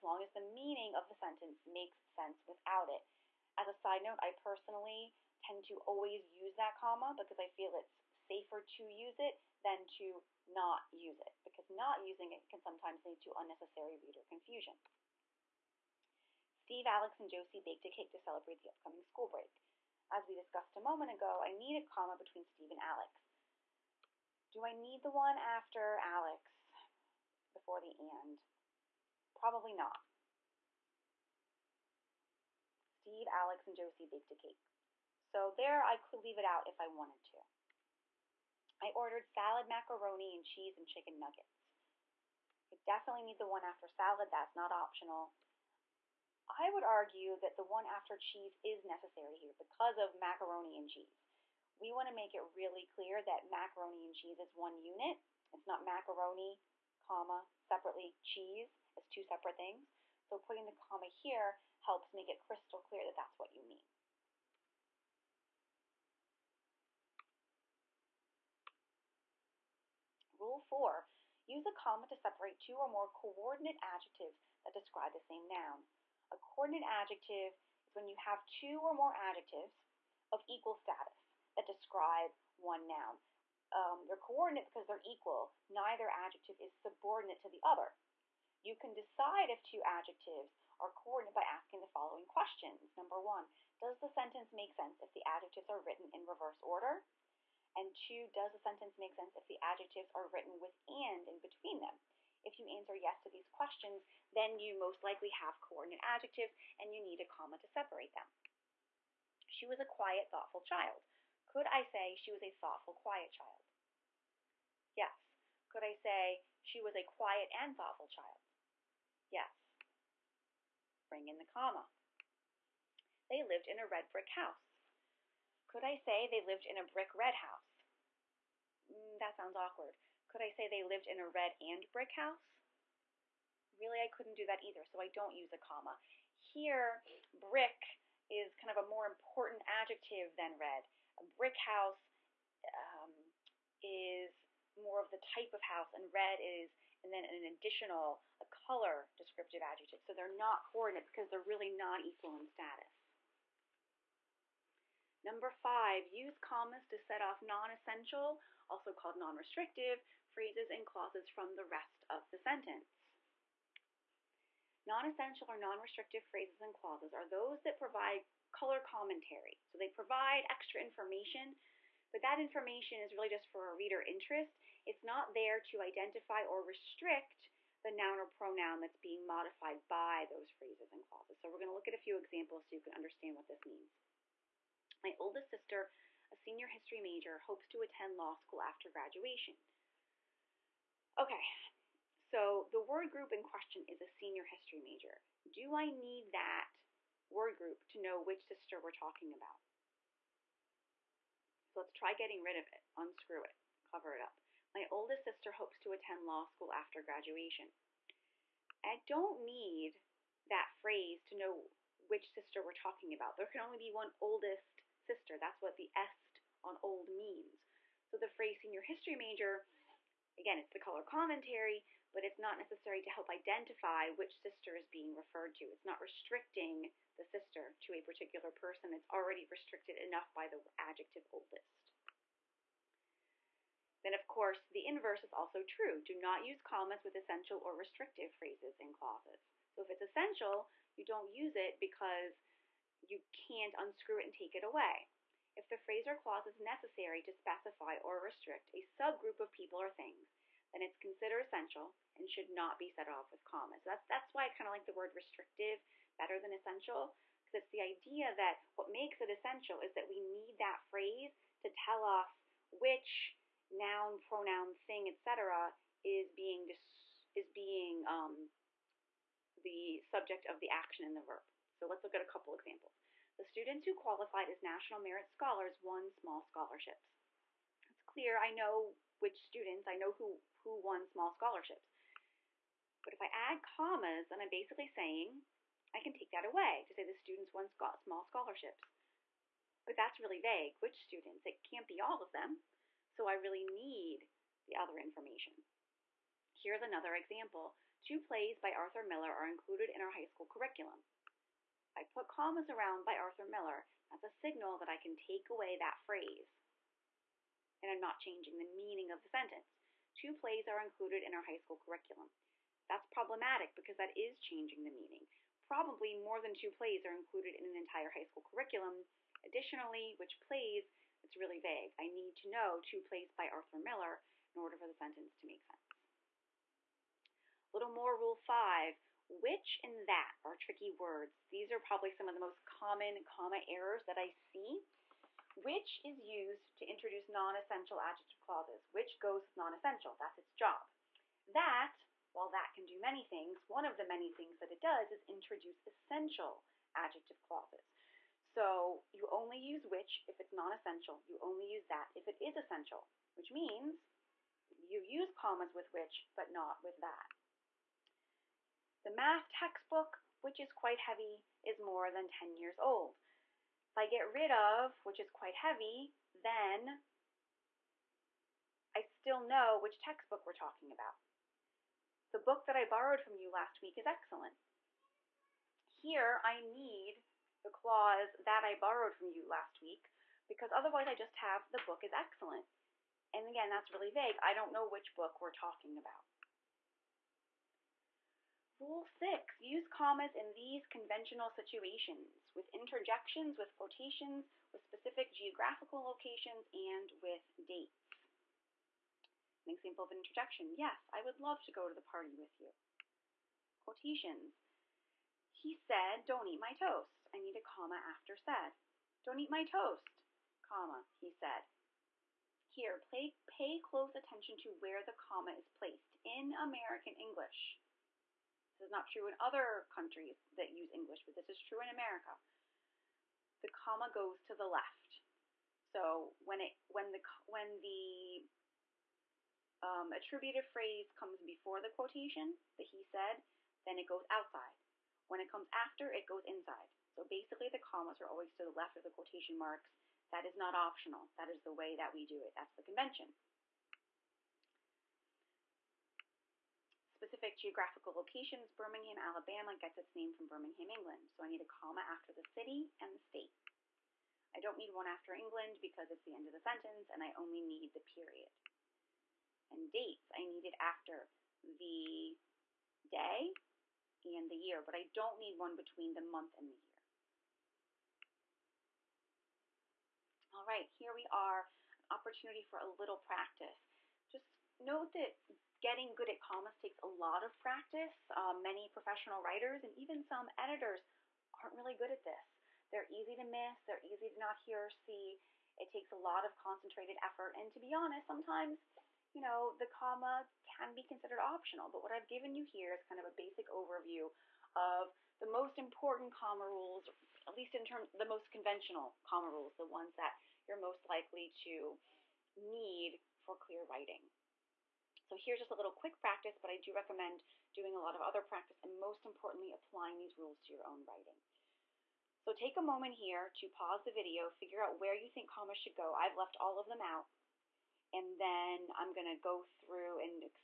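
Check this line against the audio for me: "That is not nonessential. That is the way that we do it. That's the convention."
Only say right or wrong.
wrong.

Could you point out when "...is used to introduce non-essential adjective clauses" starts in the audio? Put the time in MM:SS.
05:36.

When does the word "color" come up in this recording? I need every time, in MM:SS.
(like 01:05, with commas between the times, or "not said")
02:28, 02:48, 03:40.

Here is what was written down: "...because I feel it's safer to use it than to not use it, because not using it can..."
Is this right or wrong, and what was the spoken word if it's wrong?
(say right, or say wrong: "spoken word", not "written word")
right.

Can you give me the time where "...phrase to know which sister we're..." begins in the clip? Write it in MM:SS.
03:30.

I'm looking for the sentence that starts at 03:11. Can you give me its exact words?
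Okay, so the word group in question is a senior history major.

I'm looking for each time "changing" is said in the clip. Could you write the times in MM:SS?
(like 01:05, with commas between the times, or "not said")
05:08, 05:14.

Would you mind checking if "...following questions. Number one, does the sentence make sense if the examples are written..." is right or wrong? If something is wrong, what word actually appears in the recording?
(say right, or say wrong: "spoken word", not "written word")
wrong: "adjectives", not "examples".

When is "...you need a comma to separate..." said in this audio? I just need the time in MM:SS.
01:46.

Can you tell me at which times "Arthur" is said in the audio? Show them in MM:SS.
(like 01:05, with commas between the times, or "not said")
04:58, 05:03, 05:23.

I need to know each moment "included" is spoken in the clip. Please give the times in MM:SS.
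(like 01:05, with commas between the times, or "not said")
04:59, 05:10, 05:17.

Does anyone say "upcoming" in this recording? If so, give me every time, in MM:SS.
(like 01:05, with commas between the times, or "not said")
00:18.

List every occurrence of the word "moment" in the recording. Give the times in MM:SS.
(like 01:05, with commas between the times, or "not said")
00:20, 08:32.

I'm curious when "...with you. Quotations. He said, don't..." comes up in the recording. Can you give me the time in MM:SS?
06:42.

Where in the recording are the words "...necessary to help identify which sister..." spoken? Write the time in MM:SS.
03:42.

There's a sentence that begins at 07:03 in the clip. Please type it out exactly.
The comma goes to the left.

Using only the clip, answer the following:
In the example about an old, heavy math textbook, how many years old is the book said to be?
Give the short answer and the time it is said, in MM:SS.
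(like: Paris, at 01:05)
10, at 06:02.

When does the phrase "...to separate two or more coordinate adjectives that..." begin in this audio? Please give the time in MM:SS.
01:12.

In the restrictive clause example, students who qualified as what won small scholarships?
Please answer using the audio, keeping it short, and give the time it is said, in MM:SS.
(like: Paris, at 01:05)
National Merit Scholars, at 04:34.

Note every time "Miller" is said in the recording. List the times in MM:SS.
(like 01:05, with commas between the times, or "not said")
04:59, 05:03, 05:23.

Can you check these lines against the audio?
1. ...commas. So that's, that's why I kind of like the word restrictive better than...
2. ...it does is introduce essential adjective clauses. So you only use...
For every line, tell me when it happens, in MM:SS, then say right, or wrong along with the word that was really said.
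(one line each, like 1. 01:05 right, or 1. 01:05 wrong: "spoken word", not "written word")
1. 04:13 right
2. 05:44 right.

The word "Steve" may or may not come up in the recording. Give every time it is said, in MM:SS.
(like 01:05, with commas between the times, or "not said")
00:16, 00:22, 00:32.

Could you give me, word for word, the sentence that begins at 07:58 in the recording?
Uh, many professional writers and even some editors aren't really good at this.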